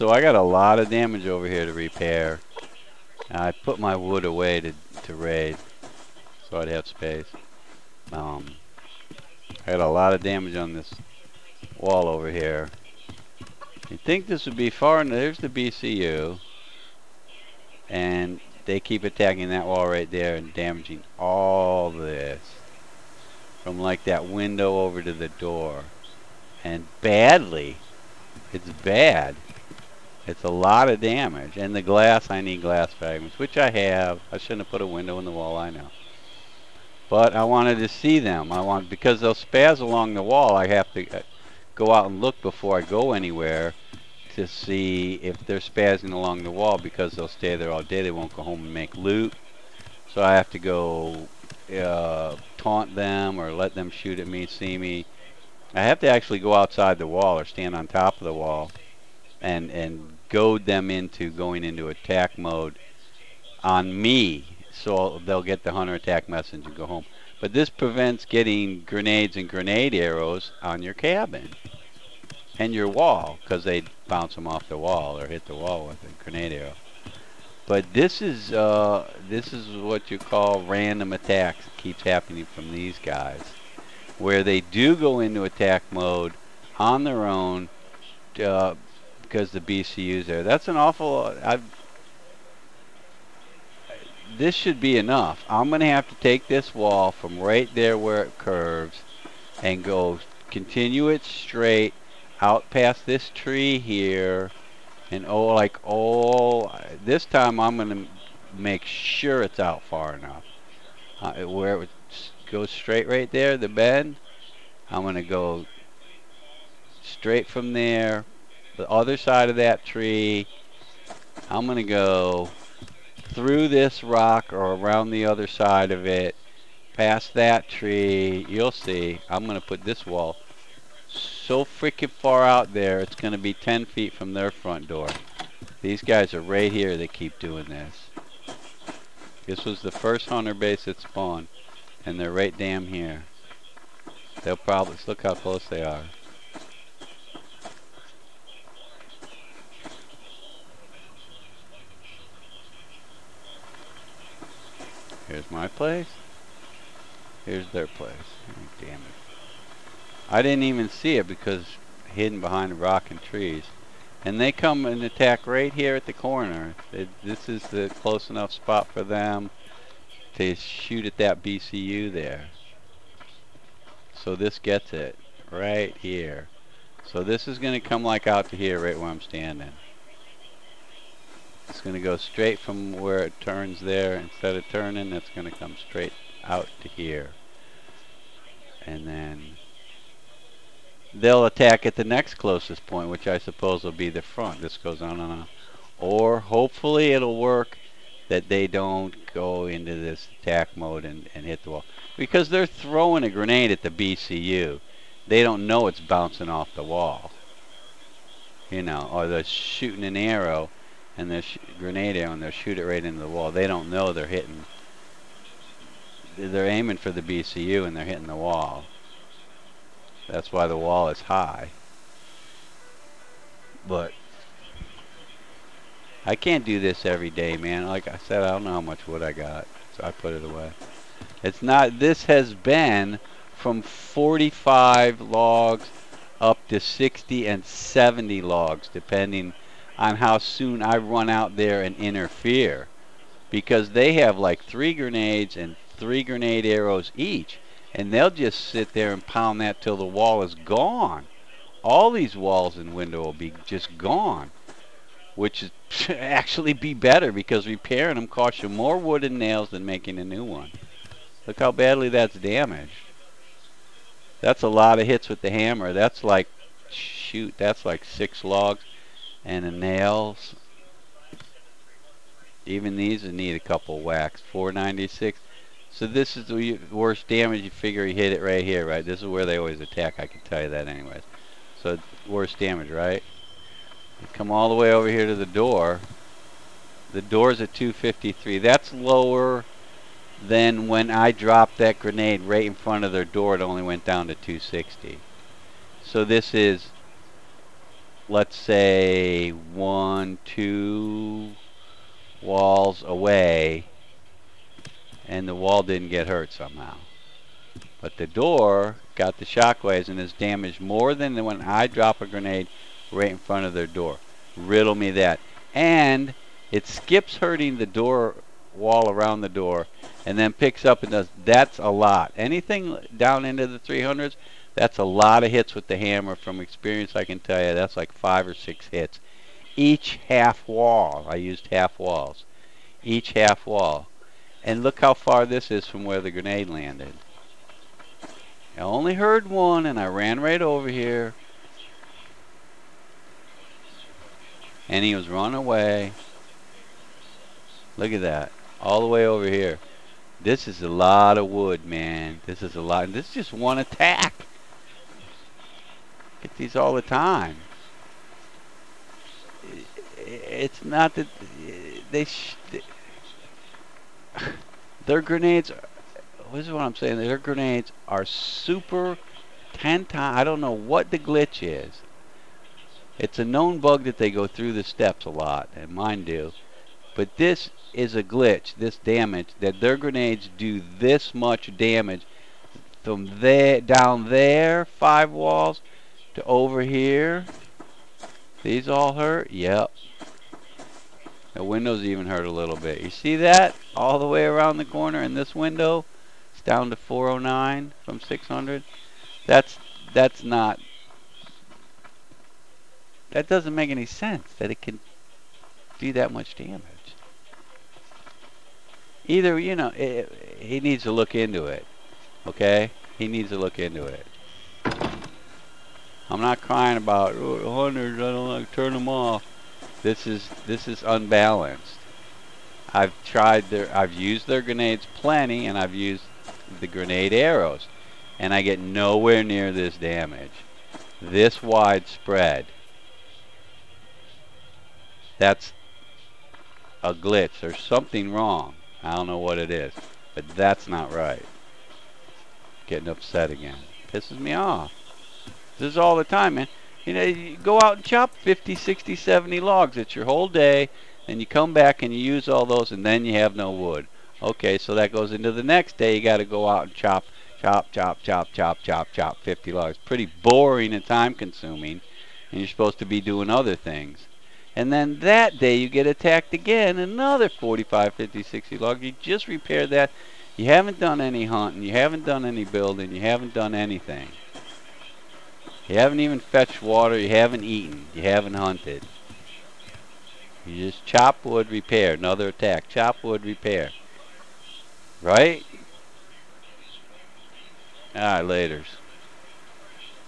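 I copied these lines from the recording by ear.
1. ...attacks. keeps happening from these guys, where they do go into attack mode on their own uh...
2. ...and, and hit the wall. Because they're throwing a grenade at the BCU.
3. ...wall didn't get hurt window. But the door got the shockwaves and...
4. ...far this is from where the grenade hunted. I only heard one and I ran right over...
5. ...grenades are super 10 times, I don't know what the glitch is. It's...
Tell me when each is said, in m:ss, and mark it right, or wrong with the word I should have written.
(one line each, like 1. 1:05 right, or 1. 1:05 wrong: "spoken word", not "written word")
1. 1:21 right
2. 3:21 right
3. 5:05 wrong: "somehow", not "window"
4. 5:35 wrong: "landed", not "hunted"
5. 6:07 right.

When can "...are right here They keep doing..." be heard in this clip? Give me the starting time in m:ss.
2:16.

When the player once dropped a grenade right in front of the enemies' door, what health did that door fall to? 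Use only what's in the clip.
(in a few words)
260.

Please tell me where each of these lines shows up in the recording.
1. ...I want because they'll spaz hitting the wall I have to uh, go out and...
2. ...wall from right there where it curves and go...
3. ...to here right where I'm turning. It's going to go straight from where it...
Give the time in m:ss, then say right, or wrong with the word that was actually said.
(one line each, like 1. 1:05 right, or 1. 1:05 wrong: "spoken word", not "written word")
1. 0:38 wrong: "along", not "hitting"
2. 1:36 right
3. 2:58 wrong: "standing", not "turning".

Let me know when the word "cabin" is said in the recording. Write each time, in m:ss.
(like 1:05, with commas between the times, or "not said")
1:10.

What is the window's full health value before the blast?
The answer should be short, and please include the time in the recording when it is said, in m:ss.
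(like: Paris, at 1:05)
600, at 6:38.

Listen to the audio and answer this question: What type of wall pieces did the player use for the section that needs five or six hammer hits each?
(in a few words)
Half walls.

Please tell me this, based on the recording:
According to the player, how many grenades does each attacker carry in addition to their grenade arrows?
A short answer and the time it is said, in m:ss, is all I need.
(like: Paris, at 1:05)
3, at 4:04.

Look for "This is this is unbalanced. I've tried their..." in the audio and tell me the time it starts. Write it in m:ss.
7:00.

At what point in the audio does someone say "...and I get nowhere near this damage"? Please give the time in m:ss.
7:08.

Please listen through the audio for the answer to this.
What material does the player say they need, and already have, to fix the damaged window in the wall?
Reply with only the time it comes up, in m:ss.
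0:32.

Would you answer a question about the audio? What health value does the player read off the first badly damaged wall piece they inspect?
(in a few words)
496.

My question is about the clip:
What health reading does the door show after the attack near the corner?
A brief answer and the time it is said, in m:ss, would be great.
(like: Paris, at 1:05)
253, at 4:47.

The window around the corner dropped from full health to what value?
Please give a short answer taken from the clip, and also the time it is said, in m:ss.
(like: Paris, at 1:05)
409, at 6:36.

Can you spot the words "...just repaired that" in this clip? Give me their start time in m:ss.
7:49.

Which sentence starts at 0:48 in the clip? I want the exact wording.
They won't go home and make loot.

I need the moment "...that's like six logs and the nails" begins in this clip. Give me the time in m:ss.
4:27.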